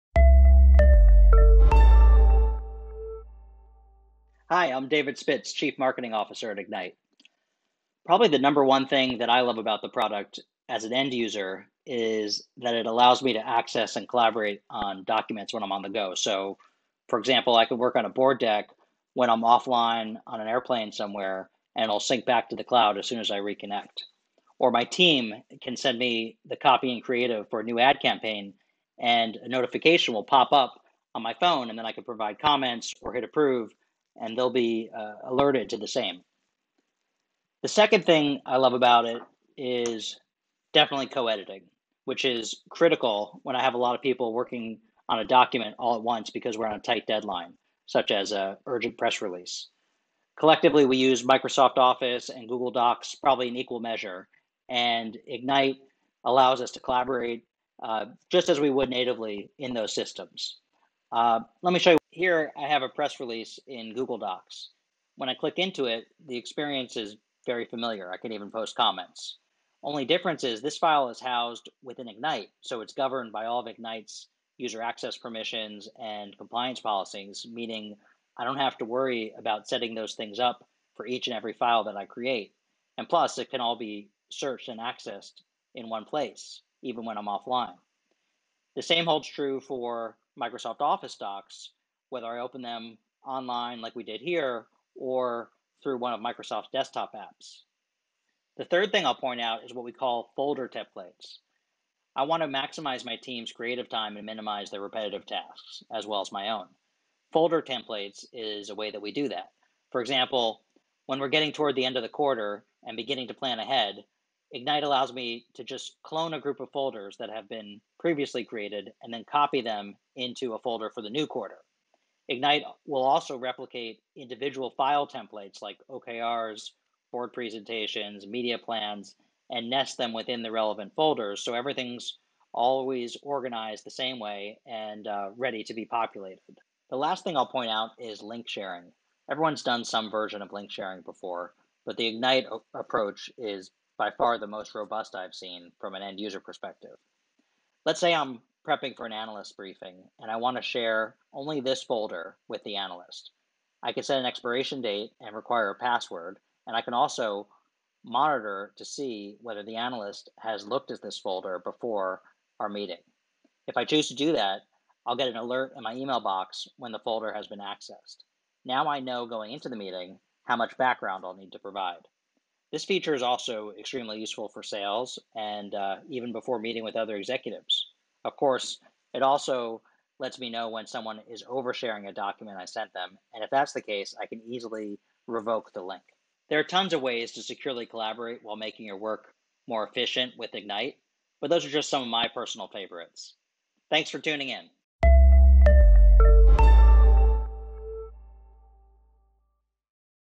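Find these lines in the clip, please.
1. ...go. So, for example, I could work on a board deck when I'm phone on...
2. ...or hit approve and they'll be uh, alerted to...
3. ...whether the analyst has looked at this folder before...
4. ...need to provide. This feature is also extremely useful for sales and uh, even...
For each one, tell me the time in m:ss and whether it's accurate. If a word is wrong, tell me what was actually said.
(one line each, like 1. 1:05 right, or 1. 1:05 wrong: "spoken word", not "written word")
1. 0:15 wrong: "offline", not "phone"
2. 0:32 right
3. 2:39 right
4. 2:51 right.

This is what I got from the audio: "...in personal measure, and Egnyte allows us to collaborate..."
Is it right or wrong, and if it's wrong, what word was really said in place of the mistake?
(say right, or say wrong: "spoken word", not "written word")
wrong: "equal", not "personal".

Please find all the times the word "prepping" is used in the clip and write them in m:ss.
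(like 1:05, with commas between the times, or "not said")
2:28.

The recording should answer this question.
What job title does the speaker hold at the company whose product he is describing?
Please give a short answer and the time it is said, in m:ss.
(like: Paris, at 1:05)
Chief Marketing Officer, at 0:05.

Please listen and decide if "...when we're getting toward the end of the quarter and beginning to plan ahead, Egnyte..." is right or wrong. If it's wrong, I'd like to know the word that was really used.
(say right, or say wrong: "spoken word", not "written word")
right.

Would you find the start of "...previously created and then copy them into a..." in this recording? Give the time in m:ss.
1:58.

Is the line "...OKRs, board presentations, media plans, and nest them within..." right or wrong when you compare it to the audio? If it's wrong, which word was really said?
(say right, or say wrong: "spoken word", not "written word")
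right.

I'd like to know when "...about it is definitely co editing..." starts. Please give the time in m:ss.
0:38.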